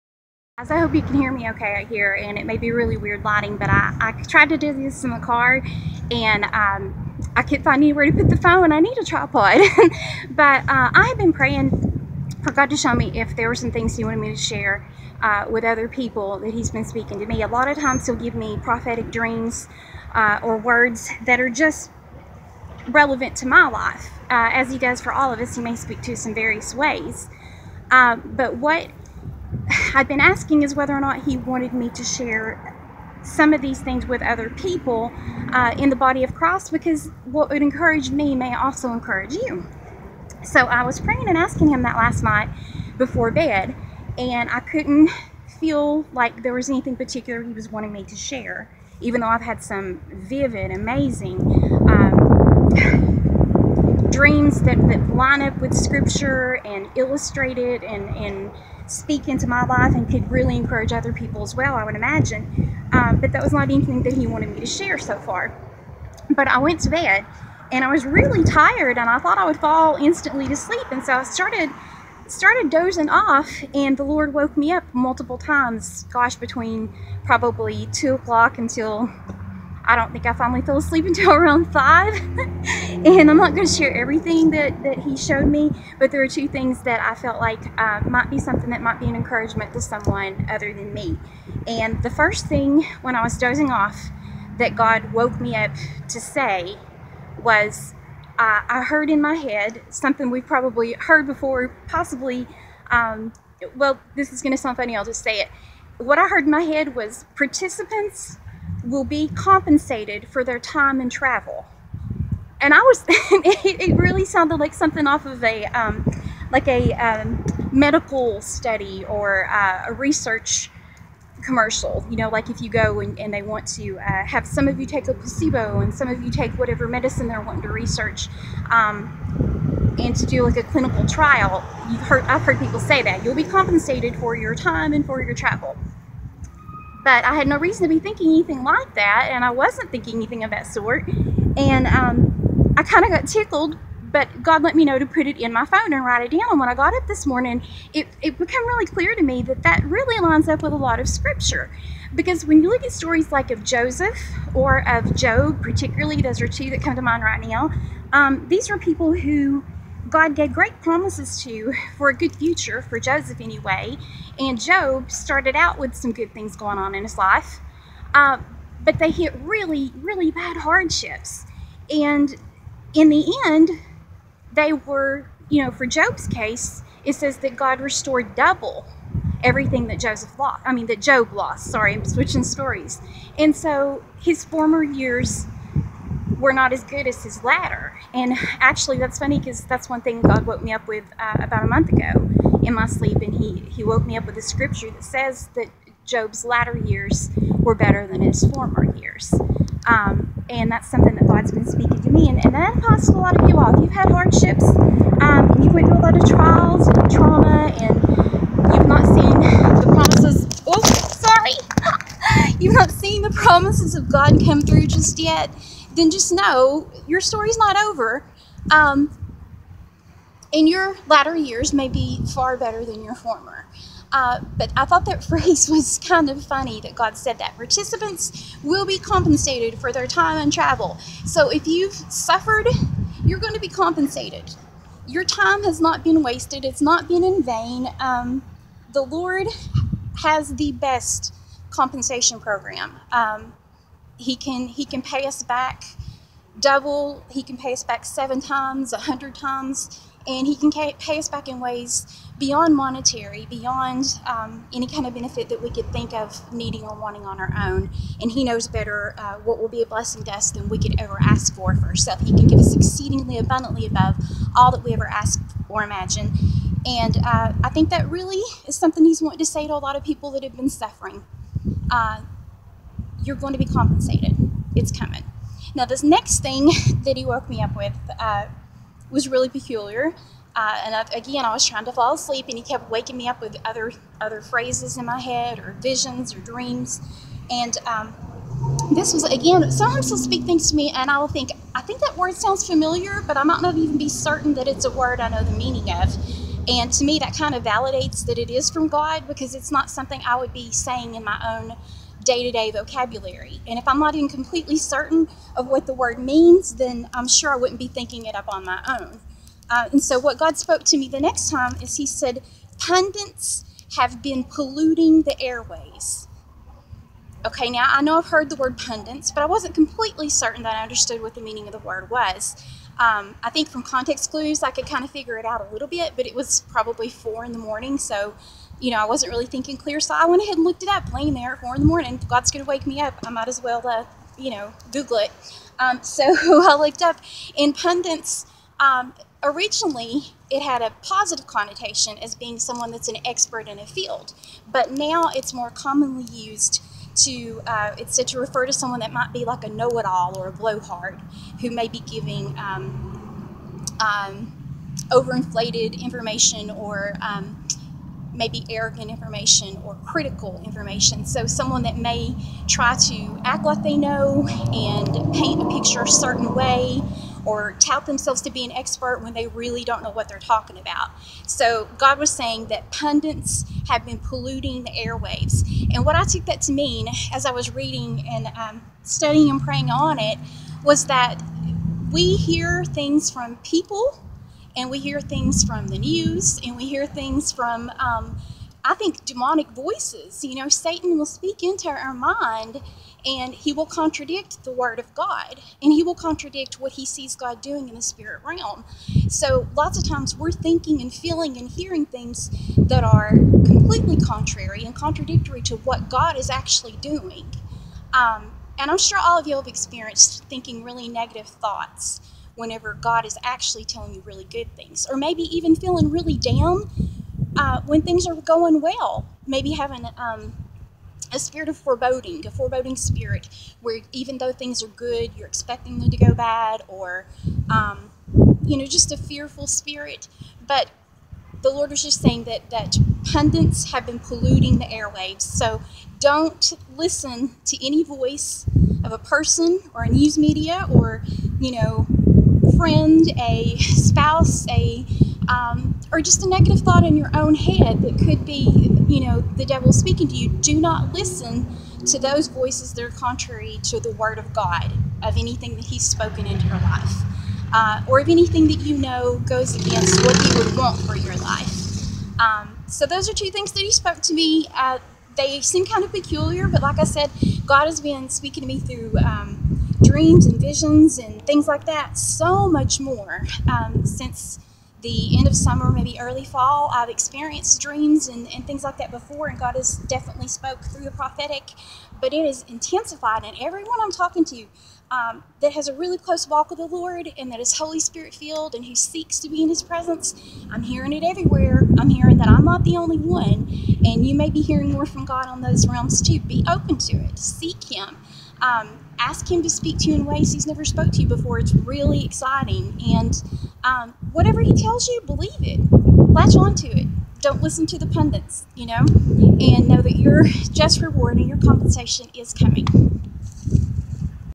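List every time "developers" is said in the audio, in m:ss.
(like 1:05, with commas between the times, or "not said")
not said.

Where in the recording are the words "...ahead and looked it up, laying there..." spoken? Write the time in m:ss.
5:30.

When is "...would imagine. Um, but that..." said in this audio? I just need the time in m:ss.
1:01.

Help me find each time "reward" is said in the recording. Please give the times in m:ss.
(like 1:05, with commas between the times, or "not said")
8:31.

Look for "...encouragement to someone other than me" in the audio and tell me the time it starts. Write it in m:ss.
1:29.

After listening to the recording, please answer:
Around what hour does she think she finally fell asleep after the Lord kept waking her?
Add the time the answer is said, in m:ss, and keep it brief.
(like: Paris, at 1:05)
5, at 1:21.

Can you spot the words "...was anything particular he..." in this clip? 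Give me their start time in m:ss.
0:46.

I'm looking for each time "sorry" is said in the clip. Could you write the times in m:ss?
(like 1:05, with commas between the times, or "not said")
3:01, 3:30.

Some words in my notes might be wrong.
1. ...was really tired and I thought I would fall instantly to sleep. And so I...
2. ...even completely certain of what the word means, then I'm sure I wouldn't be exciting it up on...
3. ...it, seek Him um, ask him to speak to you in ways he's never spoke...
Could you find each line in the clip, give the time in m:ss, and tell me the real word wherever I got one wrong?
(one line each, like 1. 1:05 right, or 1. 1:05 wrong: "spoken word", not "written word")
1. 1:07 right
2. 5:04 wrong: "thinking", not "exciting"
3. 8:17 right.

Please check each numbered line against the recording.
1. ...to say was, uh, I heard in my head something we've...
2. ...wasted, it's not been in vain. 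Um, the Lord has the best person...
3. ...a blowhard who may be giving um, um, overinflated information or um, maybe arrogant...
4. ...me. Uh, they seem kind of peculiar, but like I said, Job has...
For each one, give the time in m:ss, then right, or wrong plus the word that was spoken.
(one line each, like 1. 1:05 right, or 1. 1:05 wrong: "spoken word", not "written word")
1. 1:36 right
2. 3:56 wrong: "compensation", not "person"
3. 5:50 right
4. 7:44 wrong: "God", not "Job".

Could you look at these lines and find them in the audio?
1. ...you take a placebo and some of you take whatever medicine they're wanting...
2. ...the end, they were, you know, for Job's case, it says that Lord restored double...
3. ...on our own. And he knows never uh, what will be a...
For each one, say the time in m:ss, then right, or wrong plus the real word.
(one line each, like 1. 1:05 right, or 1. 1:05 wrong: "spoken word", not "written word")
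1. 2:04 right
2. 2:53 wrong: "God", not "Lord"
3. 4:17 wrong: "better", not "never".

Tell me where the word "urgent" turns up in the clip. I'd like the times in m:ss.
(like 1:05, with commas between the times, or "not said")
not said.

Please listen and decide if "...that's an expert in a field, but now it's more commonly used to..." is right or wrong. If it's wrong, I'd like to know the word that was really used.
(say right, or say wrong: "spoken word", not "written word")
right.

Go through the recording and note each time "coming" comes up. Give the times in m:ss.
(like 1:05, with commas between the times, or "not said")
4:34, 8:32.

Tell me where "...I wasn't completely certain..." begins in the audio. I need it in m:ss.
5:19.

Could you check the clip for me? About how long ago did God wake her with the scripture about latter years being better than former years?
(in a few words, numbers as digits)
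A month.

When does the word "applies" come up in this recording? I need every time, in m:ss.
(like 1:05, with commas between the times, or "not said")
3:22.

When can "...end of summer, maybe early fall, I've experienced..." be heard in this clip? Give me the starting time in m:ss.
7:55.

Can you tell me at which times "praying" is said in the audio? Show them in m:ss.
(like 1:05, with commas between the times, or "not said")
0:11, 0:40, 6:19.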